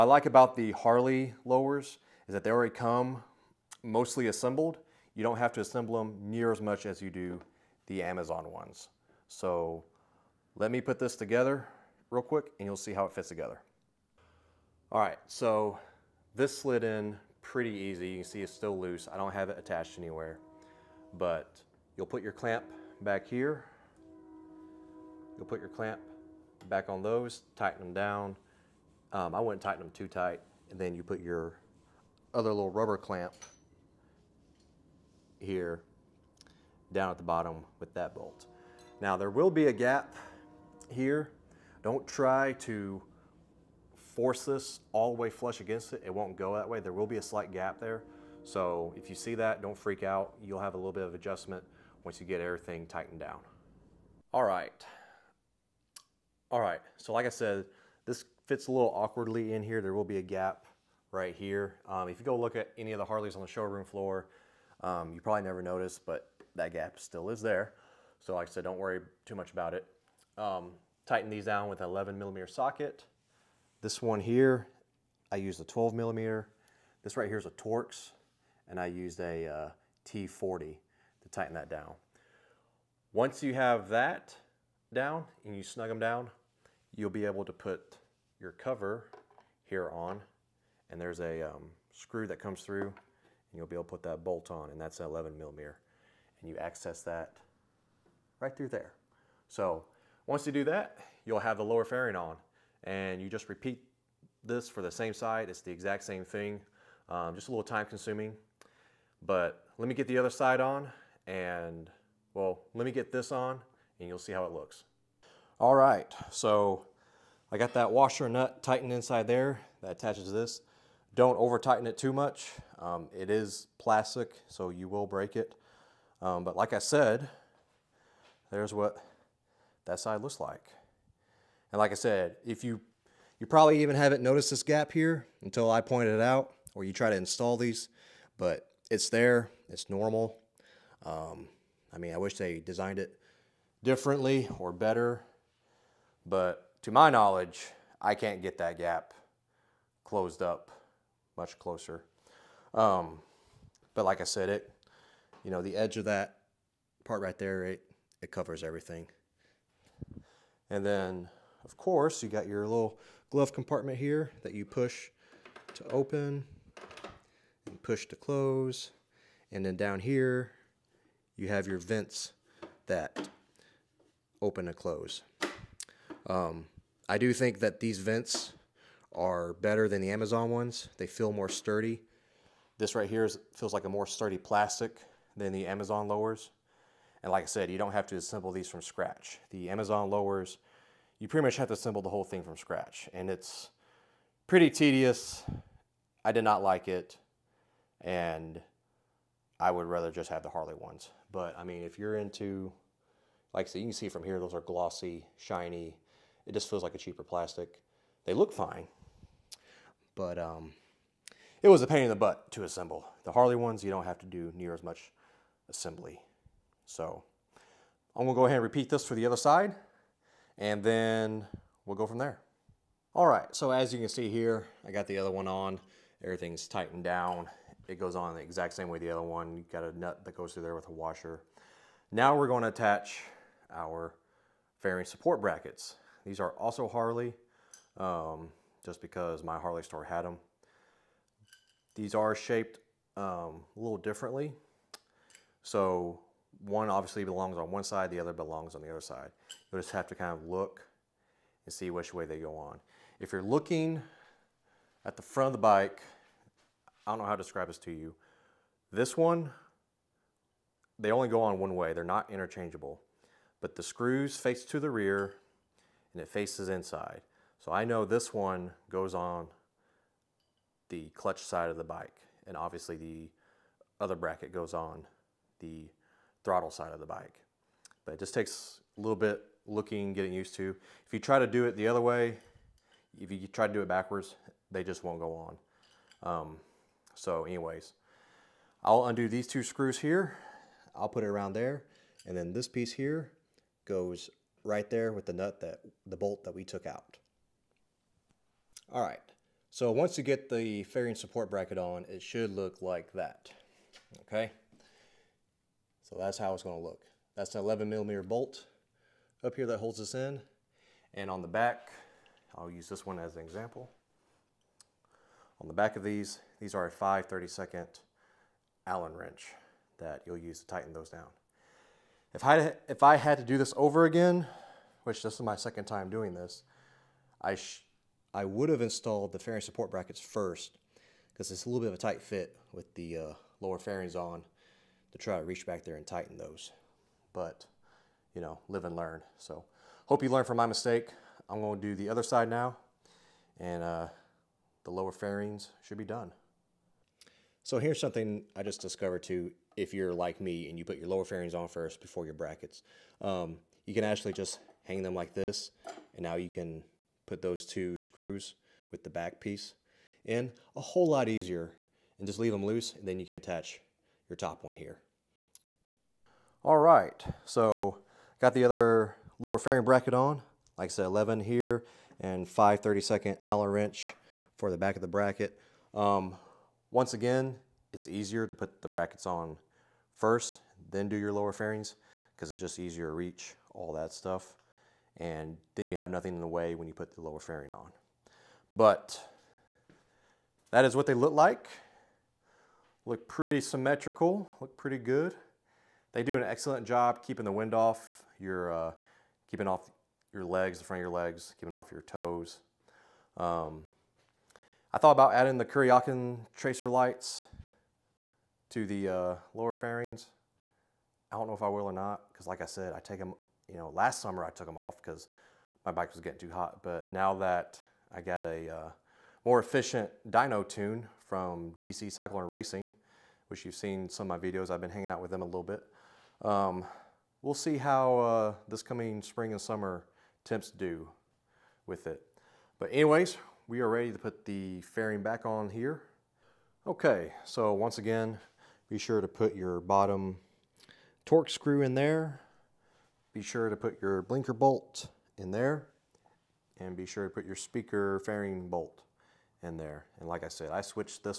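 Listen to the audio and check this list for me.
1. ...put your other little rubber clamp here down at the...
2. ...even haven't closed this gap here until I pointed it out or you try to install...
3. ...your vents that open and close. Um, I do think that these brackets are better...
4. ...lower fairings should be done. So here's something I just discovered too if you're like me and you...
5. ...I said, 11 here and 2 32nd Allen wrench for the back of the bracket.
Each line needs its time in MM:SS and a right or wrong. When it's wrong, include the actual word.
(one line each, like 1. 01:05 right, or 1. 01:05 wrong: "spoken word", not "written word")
1. 00:31 right
2. 02:13 wrong: "noticed", not "closed"
3. 02:51 wrong: "vents", not "brackets"
4. 05:44 right
5. 06:10 wrong: "5", not "2".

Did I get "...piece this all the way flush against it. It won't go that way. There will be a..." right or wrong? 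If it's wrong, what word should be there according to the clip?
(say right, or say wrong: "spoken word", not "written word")
wrong: "force", not "piece".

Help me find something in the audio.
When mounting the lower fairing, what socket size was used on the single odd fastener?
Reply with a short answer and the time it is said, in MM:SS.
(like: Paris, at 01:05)
12 millimeter, at 01:15.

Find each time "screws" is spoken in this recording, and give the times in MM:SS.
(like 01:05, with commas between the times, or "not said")
01:31, 04:23, 04:49, 05:57, 07:21.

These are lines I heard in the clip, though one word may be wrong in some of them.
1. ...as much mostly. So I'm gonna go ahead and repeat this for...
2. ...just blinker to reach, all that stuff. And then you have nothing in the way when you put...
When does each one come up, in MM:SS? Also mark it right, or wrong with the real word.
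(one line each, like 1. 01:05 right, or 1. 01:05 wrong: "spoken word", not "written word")
1. 03:34 wrong: "assembly", not "mostly"
2. 06:22 wrong: "easier", not "blinker".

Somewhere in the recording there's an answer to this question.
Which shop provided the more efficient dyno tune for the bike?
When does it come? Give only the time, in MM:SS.
07:01.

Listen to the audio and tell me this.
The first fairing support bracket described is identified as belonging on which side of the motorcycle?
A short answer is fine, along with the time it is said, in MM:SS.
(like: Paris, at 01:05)
Clutch side, at 04:31.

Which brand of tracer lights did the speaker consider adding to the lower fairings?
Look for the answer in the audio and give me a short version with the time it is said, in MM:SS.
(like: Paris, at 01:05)
Kuryakin, at 06:45.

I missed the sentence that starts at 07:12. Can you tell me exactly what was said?
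But anyways, we are ready to put the fairing back on here.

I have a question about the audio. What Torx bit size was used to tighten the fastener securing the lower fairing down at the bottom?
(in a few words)
T40.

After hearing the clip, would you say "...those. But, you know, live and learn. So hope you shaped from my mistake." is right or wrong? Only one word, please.
wrong.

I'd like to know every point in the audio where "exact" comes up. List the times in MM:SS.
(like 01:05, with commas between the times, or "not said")
01:45, 03:48.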